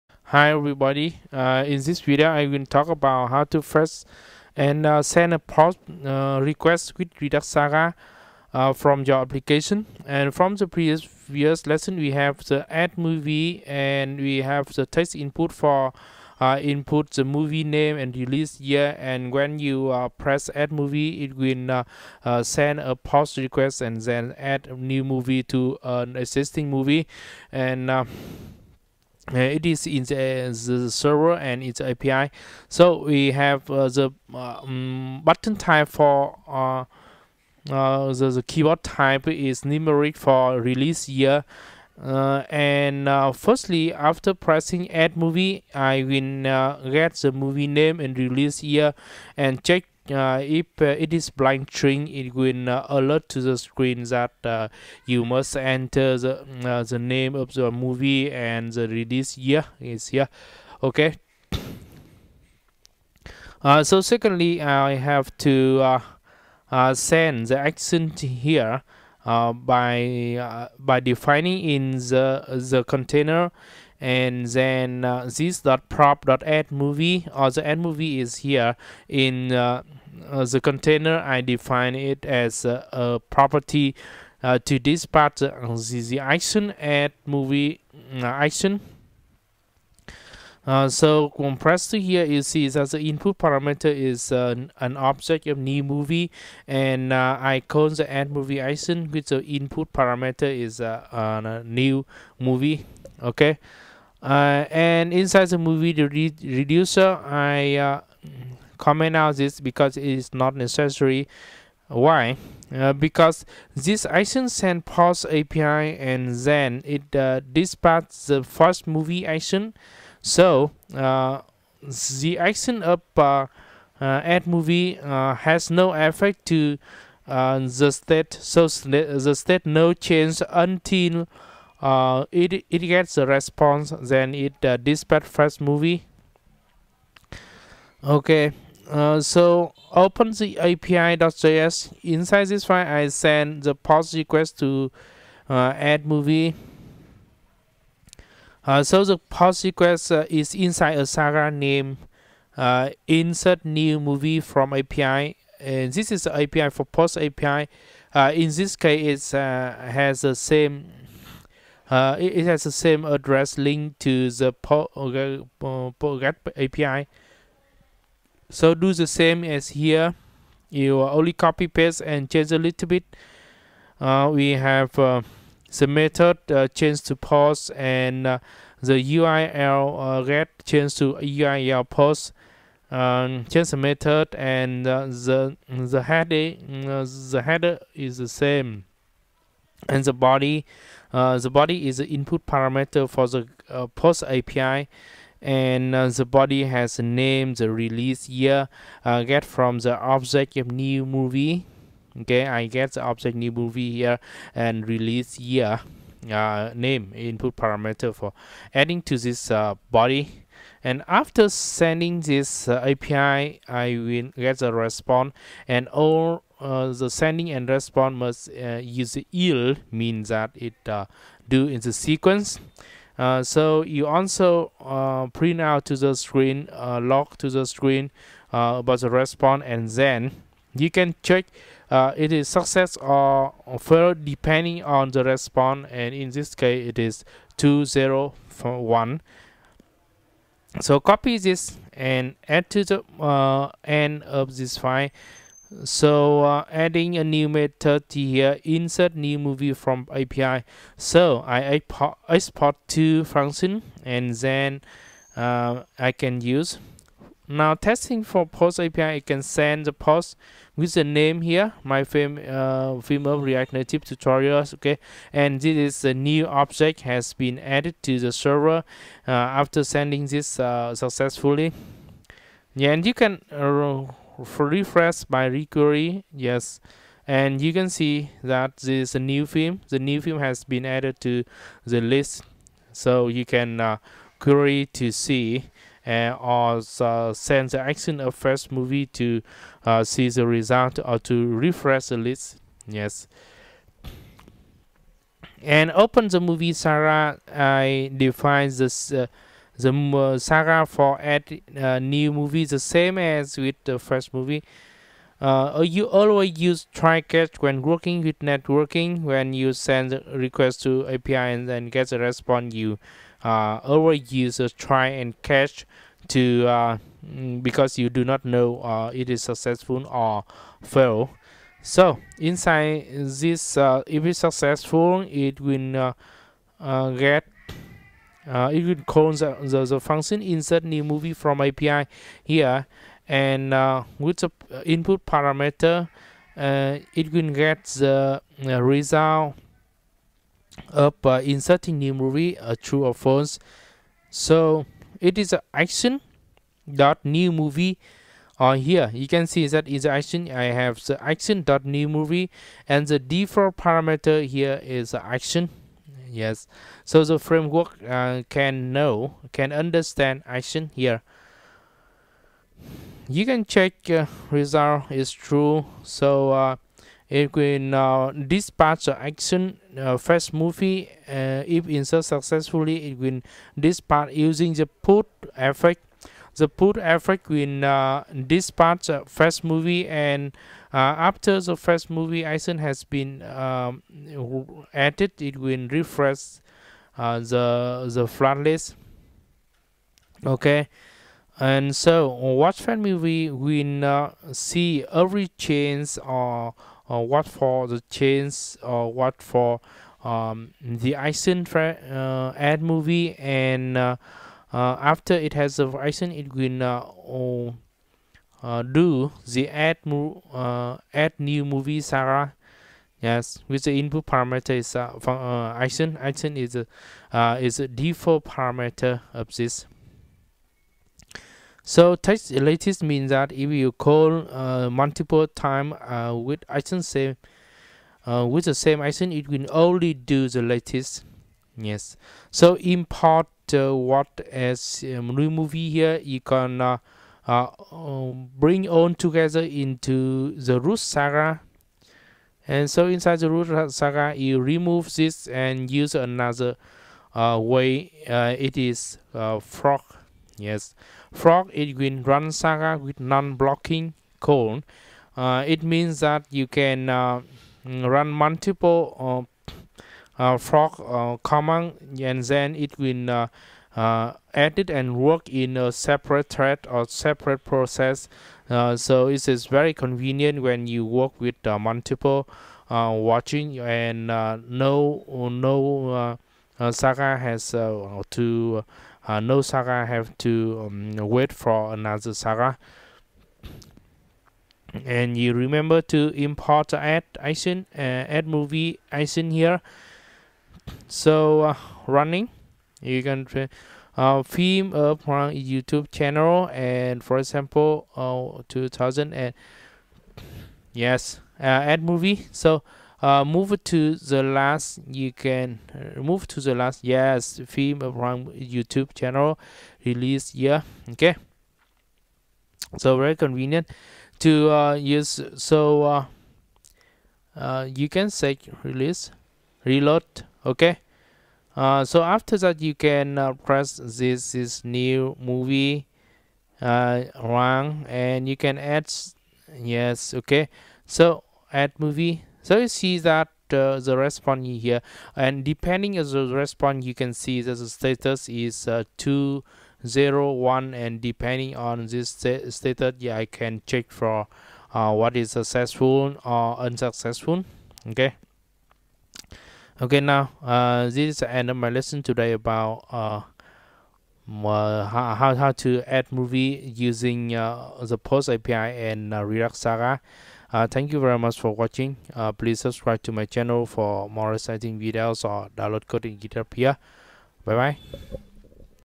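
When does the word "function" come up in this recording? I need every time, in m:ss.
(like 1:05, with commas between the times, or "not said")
4:13, 5:29.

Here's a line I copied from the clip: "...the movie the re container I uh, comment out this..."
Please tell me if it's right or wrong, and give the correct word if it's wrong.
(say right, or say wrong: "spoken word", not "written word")
wrong: "reducer", not "container".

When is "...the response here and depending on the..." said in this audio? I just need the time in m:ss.
8:53.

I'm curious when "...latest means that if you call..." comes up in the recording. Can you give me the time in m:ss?
7:02.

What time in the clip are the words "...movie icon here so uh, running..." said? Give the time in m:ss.
8:08.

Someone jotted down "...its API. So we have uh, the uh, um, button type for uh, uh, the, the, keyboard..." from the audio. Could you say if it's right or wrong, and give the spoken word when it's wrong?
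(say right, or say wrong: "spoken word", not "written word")
right.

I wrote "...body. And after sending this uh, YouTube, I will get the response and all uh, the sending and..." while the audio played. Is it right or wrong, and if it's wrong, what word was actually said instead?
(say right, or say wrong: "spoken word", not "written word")
wrong: "API", not "YouTube".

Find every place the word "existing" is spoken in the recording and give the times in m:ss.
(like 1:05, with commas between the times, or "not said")
0:26.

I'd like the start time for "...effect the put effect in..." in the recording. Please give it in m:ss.
6:15.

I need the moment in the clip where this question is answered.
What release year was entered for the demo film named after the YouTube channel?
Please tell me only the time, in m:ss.
8:18.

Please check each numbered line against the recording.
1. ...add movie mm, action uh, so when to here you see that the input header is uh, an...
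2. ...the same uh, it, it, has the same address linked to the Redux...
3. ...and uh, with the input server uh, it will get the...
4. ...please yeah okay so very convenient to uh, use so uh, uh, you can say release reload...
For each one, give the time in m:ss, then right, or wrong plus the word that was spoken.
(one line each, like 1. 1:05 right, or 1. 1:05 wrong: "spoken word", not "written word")
1. 1:26 wrong: "parameter", not "header"
2. 2:40 wrong: "PostGET", not "Redux"
3. 5:33 wrong: "parameter", not "server"
4. 8:30 wrong: "release", not "please".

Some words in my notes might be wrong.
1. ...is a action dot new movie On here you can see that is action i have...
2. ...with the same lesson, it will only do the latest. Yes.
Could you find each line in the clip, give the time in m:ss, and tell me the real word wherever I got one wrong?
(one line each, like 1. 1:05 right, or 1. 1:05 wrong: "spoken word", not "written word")
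1. 5:45 right
2. 7:08 wrong: "action", not "lesson".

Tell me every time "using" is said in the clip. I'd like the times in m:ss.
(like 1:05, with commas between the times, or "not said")
6:14, 9:16.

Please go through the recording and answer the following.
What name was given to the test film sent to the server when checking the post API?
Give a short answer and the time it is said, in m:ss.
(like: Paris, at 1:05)
film of react native tutorials, at 4:23.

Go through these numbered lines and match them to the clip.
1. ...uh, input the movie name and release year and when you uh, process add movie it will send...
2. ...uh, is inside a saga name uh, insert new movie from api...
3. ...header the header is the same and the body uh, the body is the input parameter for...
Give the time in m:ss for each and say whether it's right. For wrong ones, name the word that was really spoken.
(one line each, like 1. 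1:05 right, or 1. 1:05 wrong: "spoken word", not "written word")
1. 0:16 wrong: "press", not "process"
2. 2:30 right
3. 3:06 right.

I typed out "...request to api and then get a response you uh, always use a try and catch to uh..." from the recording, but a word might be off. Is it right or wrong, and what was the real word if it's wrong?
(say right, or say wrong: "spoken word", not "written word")
right.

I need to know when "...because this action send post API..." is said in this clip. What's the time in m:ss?
1:52.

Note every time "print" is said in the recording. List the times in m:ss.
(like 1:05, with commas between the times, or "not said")
3:45.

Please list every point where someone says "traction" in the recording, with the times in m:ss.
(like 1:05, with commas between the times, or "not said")
not said.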